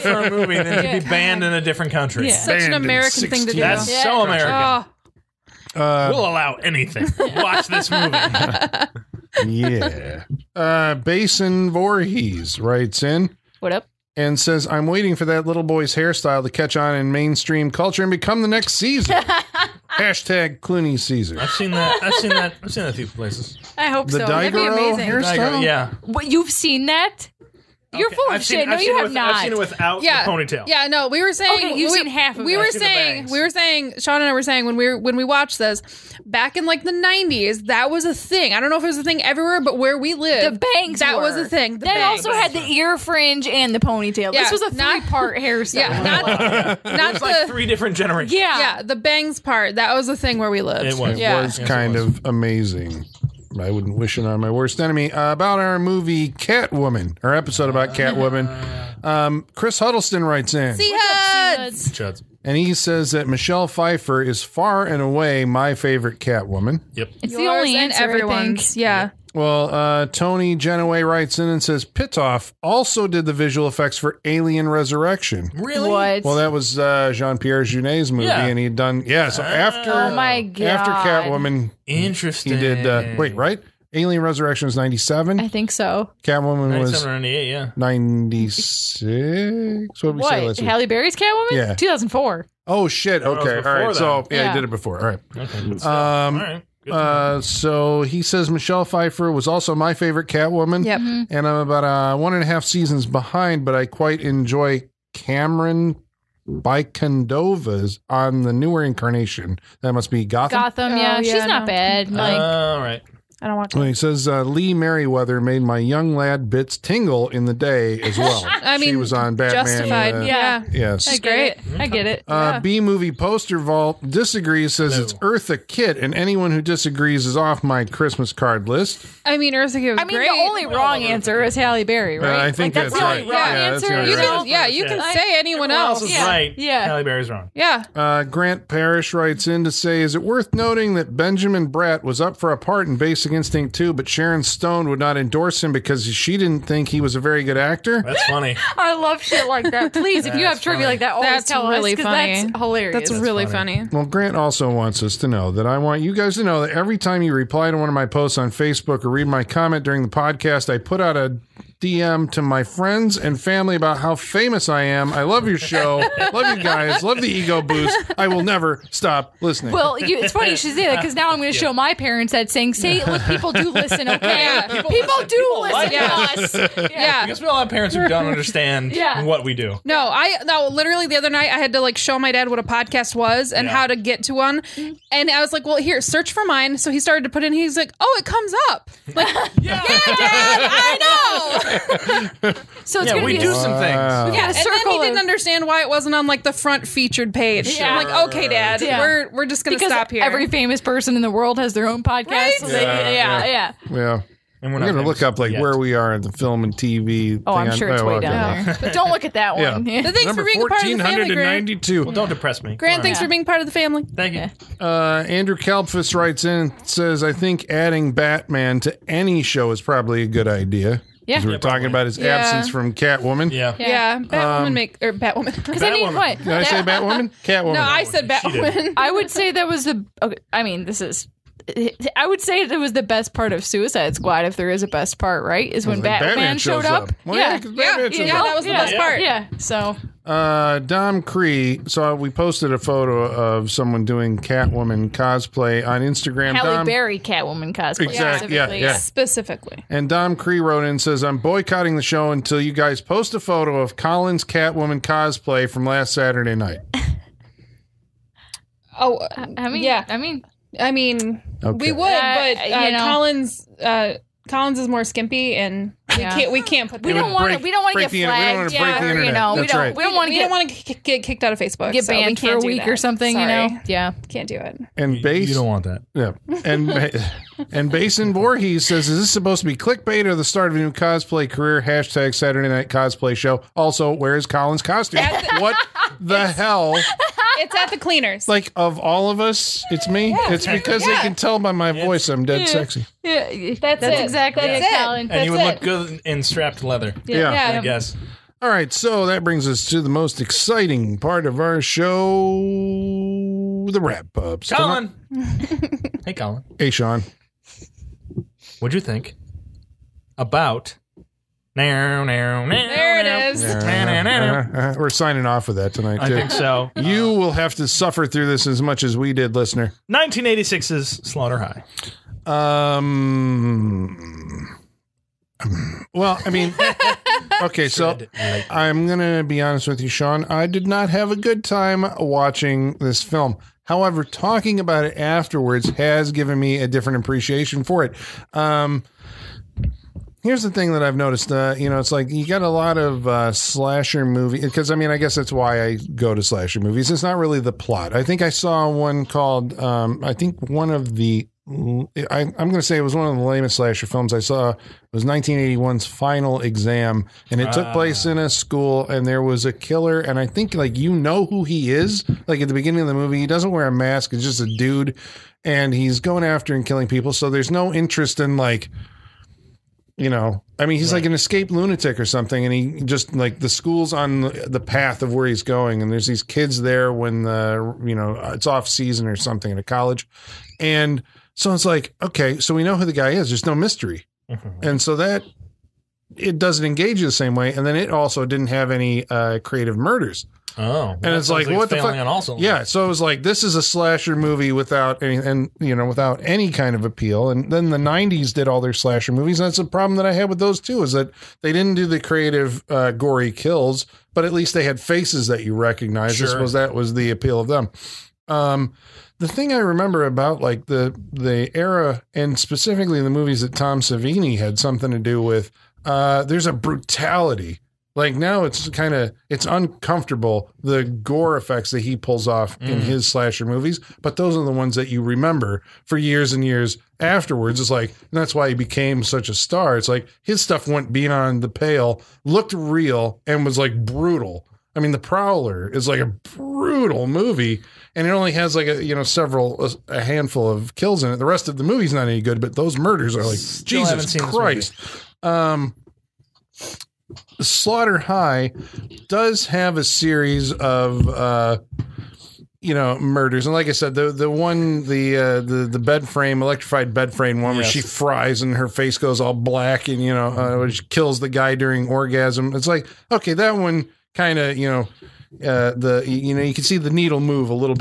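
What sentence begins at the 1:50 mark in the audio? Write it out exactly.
Gotham, yeah, oh, yeah, she's not no.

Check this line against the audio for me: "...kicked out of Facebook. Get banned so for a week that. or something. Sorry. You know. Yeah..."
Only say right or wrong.
right.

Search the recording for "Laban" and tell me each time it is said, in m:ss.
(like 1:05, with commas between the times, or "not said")
not said.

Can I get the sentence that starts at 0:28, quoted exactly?
Seen, no, I've you have with, not.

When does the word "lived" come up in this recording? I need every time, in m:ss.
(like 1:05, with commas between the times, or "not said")
0:40, 0:50.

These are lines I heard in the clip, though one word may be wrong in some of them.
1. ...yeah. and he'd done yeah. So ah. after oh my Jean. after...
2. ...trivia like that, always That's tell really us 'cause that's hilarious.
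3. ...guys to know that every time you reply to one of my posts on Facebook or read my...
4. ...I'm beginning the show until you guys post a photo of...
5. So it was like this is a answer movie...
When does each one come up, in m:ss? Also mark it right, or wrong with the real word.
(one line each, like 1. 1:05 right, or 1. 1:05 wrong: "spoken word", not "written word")
1. 1:18 wrong: "God", not "Jean"
2. 2:30 right
3. 2:36 right
4. 4:11 wrong: "boycotting", not "beginning"
5. 6:32 wrong: "slasher", not "answer".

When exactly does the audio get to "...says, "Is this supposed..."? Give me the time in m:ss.
4:38.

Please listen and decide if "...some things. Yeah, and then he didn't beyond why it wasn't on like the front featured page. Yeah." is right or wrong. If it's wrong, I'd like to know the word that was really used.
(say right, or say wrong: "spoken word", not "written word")
wrong: "understand", not "beyond".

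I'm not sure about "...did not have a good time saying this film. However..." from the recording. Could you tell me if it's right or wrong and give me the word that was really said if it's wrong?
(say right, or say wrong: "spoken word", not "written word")
wrong: "watching", not "saying".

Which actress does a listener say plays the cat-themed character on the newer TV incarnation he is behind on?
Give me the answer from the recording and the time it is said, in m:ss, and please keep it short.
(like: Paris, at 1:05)
Camren Bicondova, at 1:45.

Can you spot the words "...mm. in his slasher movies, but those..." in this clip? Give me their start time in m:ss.
7:02.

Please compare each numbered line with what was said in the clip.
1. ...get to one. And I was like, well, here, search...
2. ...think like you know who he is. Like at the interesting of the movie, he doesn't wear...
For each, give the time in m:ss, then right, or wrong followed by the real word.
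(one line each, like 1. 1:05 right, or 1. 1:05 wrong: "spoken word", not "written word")
1. 3:03 right
2. 6:00 wrong: "beginning", not "interesting".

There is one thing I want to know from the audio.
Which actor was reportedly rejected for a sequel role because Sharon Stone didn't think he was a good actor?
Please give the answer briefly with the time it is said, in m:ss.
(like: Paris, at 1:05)
Benjamin Bratt, at 2:21.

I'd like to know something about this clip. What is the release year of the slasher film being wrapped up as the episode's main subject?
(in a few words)
1986.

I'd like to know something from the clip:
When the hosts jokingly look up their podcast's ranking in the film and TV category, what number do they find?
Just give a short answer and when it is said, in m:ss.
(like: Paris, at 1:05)
1492, at 3:31.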